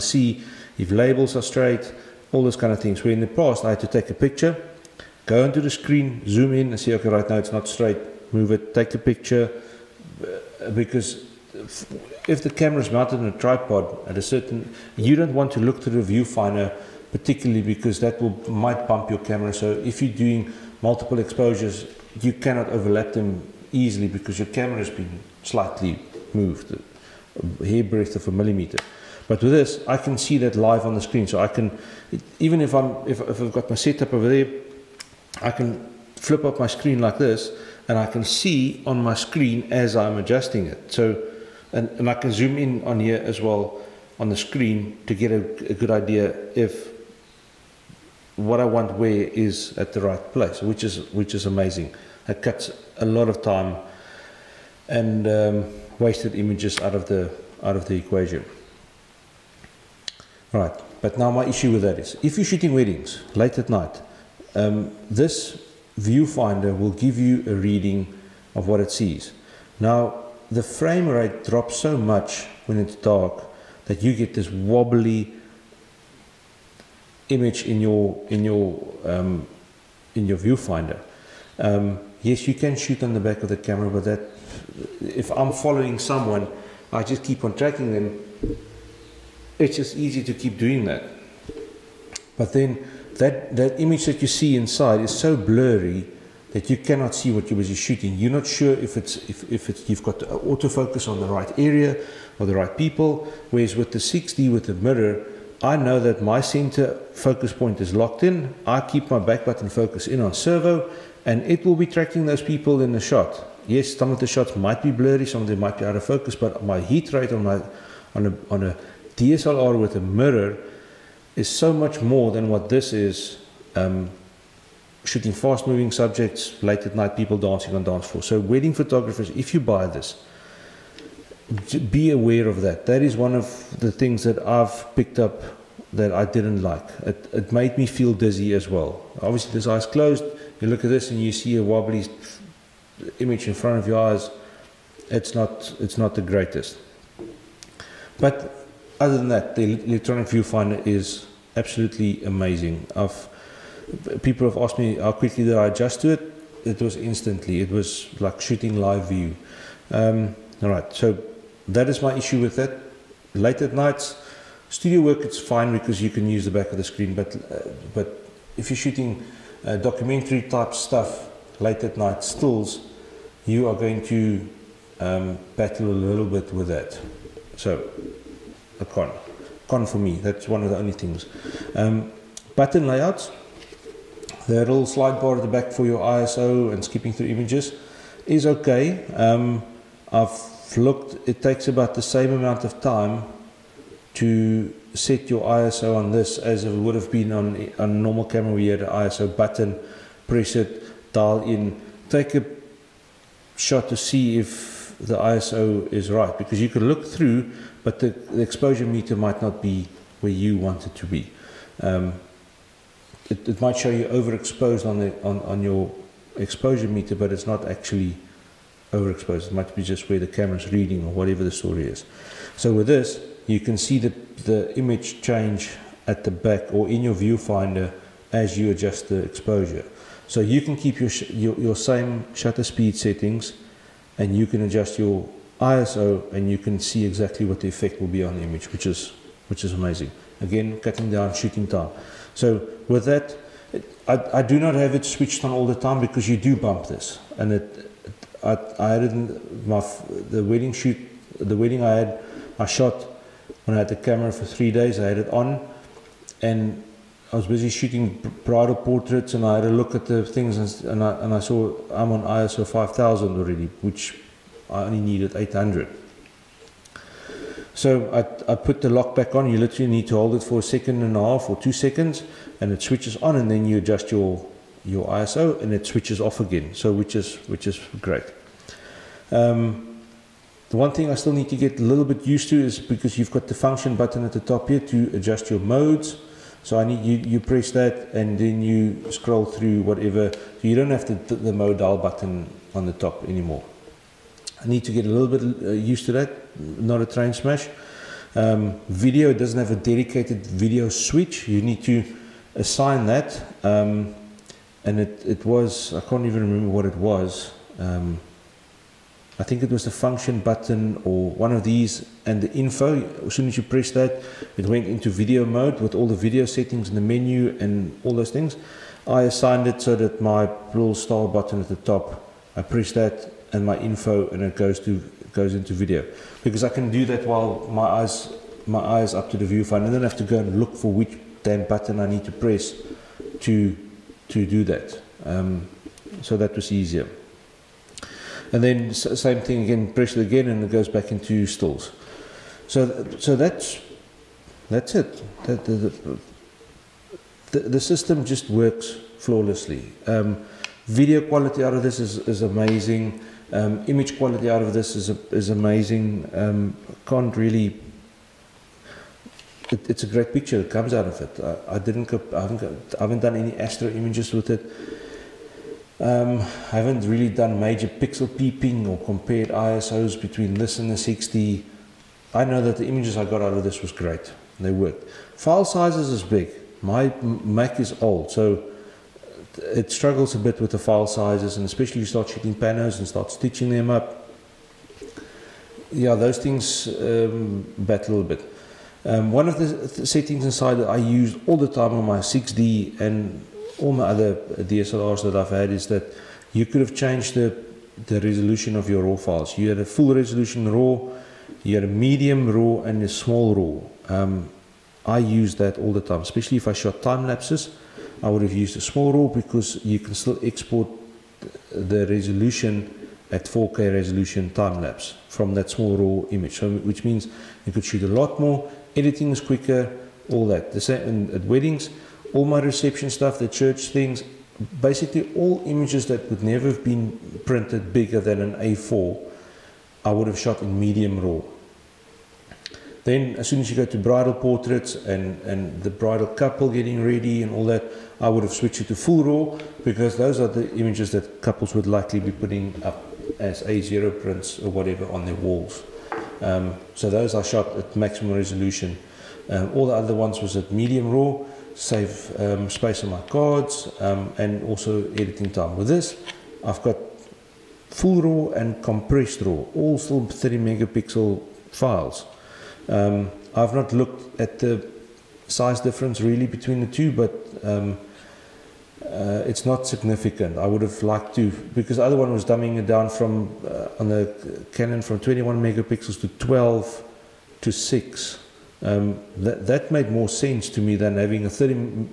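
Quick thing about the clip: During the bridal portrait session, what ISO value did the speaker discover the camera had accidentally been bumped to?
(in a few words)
5000.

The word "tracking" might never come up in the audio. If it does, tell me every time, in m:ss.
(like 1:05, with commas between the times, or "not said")
1:27, 1:51.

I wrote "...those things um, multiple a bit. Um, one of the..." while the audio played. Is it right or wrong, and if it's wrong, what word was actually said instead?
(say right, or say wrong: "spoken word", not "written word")
wrong: "battle", not "multiple".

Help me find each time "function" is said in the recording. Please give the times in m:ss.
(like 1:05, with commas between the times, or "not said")
4:43, 5:09.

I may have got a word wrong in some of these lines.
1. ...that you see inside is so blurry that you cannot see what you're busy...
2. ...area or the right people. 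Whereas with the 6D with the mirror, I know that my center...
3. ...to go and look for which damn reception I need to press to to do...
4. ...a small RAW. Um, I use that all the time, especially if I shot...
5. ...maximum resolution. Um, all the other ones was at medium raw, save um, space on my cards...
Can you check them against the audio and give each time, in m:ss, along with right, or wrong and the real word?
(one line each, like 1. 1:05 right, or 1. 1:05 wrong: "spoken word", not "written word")
1. 1:34 right
2. 1:41 right
3. 5:30 wrong: "button", not "reception"
4. 6:43 right
5. 7:27 right.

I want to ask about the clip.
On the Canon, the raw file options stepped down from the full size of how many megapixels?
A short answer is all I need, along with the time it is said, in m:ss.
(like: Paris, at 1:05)
21, at 7:55.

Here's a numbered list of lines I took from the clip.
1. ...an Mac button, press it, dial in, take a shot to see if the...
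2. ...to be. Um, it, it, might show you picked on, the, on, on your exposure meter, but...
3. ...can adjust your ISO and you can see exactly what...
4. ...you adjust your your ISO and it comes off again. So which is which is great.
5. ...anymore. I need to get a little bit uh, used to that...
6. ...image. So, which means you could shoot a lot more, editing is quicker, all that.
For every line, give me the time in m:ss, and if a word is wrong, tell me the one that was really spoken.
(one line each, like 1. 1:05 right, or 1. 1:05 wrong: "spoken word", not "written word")
1. 3:18 wrong: "ISO", not "Mac"
2. 3:30 wrong: "overexposed", not "picked"
3. 3:54 right
4. 4:33 wrong: "switches", not "comes"
5. 4:53 right
6. 6:56 right.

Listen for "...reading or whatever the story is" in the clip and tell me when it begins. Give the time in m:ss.
3:40.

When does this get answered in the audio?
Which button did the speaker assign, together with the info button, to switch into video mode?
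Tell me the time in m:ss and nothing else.
5:20.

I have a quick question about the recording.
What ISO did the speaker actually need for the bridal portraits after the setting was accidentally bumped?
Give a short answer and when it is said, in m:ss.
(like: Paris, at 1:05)
800, at 4:25.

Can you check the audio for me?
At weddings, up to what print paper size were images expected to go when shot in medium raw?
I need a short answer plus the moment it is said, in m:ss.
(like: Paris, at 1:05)
A4, at 7:08.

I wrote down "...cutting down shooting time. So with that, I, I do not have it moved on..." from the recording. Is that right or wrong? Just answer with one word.
wrong.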